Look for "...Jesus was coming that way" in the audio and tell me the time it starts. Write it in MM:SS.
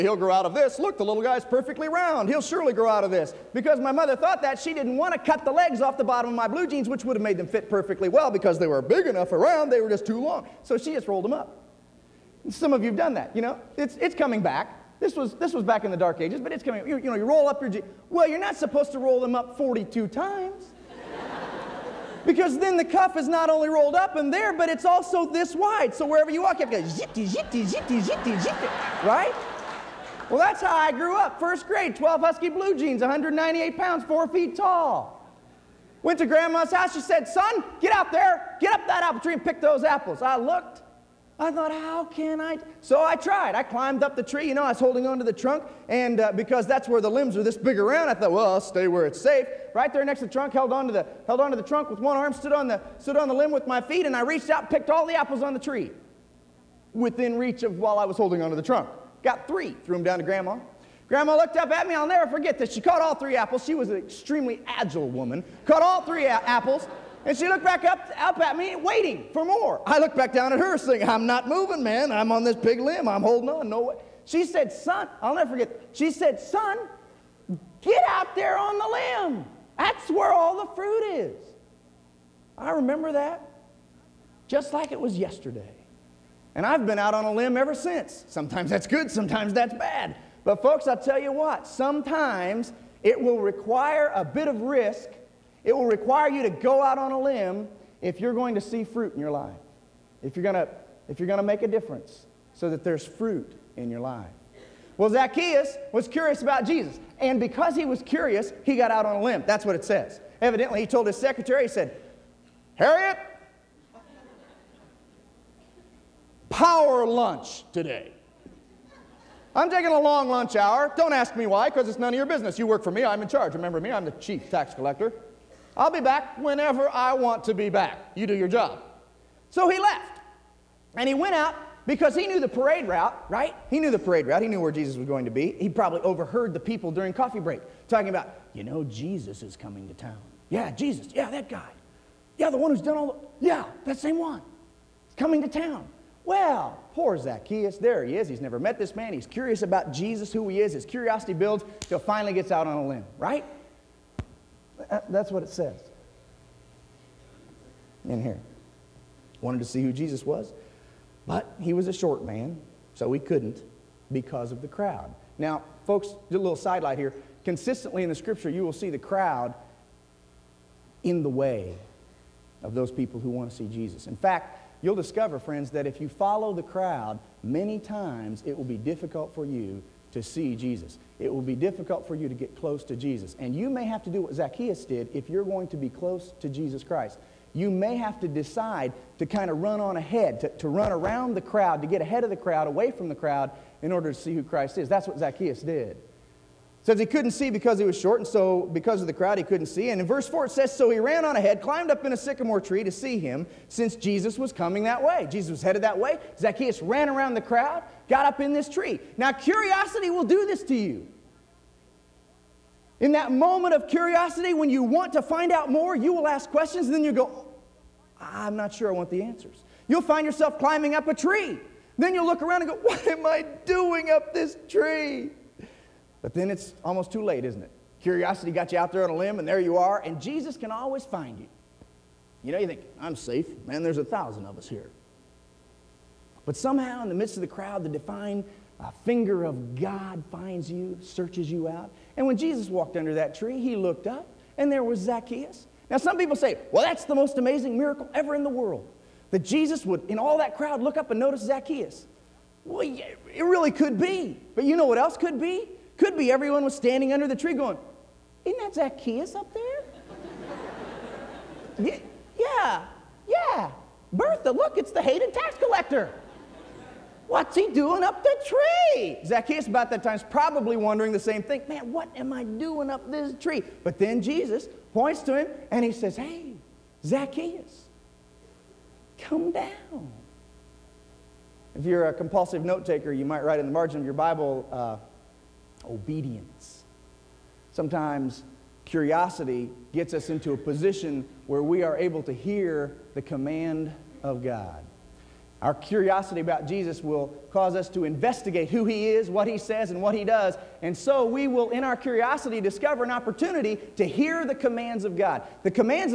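03:23.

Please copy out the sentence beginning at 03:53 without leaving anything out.
Man, there's a thousand of us here.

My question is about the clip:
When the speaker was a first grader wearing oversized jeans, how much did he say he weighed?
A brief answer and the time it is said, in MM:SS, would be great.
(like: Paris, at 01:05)
198 pounds, at 00:33.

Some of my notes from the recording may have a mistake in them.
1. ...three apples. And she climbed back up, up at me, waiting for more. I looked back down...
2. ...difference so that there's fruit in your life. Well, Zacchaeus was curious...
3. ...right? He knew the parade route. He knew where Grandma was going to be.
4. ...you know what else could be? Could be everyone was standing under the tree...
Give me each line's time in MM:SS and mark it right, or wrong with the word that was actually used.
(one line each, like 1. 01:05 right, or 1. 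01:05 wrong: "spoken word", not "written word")
1. 01:06 wrong: "looked", not "climbed"
2. 01:41 right
3. 02:13 wrong: "Jesus", not "Grandma"
4. 04:14 right.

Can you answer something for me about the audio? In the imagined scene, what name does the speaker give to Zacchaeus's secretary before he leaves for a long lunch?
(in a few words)
Harriet.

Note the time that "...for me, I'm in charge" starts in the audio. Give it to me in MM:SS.
02:02.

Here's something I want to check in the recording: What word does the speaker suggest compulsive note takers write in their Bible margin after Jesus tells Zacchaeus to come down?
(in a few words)
Obedience.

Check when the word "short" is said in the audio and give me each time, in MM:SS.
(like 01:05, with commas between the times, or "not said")
02:41, 03:17.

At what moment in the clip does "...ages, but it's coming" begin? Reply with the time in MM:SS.
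00:16.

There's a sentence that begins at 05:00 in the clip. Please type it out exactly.
And so we will, in our curiosity, discover an opportunity to hear the commands of God.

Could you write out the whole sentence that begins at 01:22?
I remember that just like it was yesterday.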